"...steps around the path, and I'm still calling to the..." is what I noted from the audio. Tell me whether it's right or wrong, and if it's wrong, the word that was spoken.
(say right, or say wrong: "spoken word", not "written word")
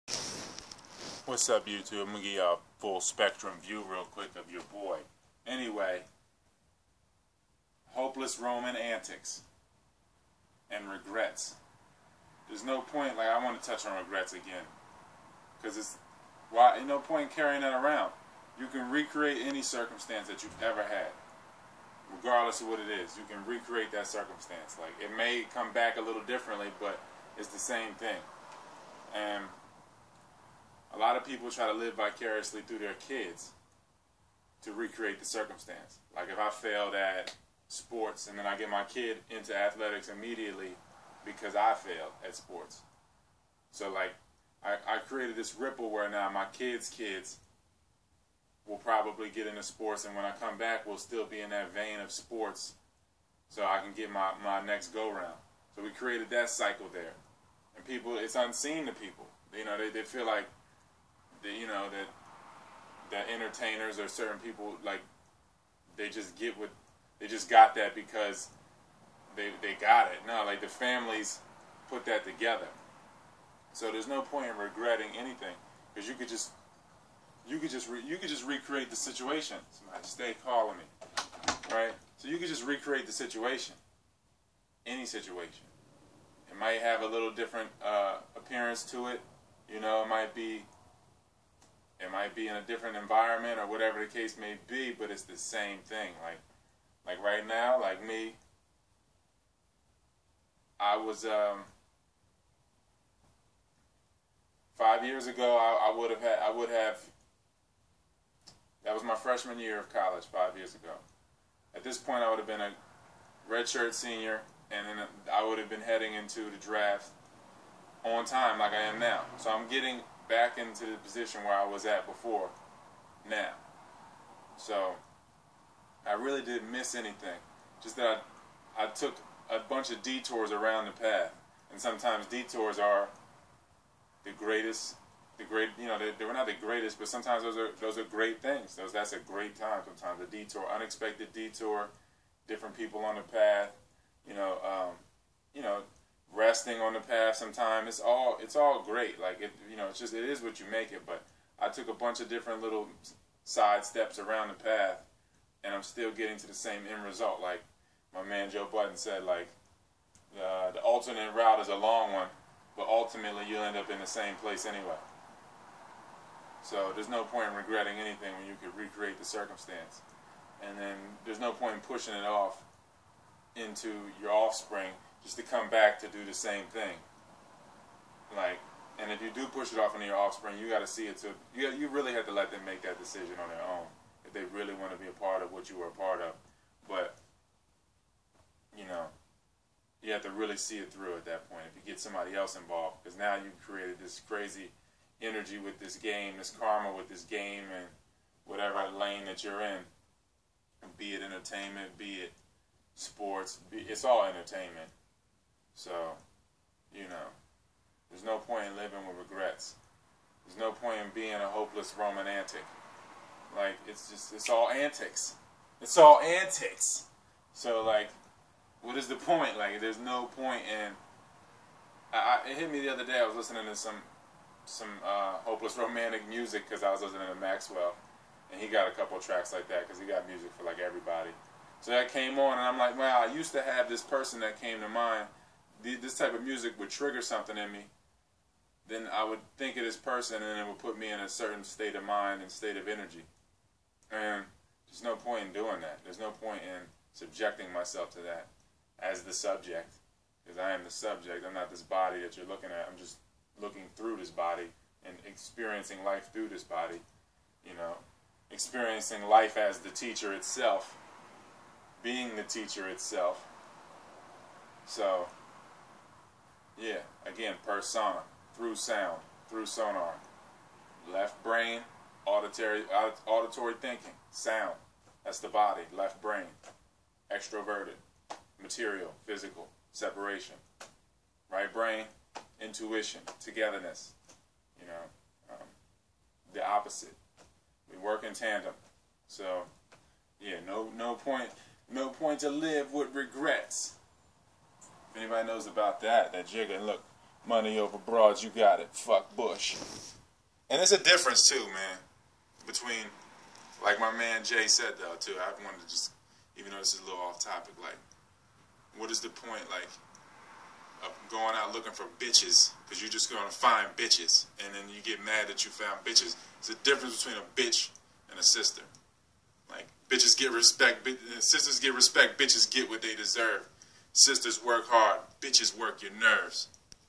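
wrong: "getting", not "calling".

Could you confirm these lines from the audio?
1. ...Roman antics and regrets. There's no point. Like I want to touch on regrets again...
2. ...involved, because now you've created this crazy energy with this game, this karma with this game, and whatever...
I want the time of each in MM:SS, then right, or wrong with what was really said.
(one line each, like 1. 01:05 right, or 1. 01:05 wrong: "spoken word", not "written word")
1. 00:08 right
2. 03:12 right.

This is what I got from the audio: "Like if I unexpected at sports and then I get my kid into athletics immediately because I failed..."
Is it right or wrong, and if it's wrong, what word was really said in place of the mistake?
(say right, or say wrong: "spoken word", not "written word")
wrong: "failed", not "unexpected".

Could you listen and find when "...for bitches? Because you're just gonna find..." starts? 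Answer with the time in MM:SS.
05:11.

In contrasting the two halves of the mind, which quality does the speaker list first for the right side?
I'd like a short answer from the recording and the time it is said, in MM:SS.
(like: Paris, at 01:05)
Intuition, at 04:42.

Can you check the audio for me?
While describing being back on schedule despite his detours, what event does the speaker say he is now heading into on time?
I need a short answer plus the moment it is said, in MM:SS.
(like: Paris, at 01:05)
The draft, at 01:56.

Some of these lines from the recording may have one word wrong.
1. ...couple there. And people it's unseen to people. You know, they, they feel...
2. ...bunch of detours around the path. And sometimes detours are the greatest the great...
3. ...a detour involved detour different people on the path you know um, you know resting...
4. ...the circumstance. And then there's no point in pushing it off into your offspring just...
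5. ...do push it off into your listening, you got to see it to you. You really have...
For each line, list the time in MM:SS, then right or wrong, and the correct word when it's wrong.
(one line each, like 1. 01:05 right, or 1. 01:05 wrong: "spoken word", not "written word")
1. 00:56 wrong: "cycle", not "couple"
2. 02:09 right
3. 02:20 wrong: "unexpected", not "involved"
4. 02:49 right
5. 02:59 wrong: "offspring", not "listening".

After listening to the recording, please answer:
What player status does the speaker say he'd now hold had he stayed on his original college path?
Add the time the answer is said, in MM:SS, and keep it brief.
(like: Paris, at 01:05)
Redshirt senior, at 01:53.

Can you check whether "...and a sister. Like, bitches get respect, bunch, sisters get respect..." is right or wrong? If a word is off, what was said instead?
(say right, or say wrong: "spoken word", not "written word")
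wrong: "bitch", not "bunch".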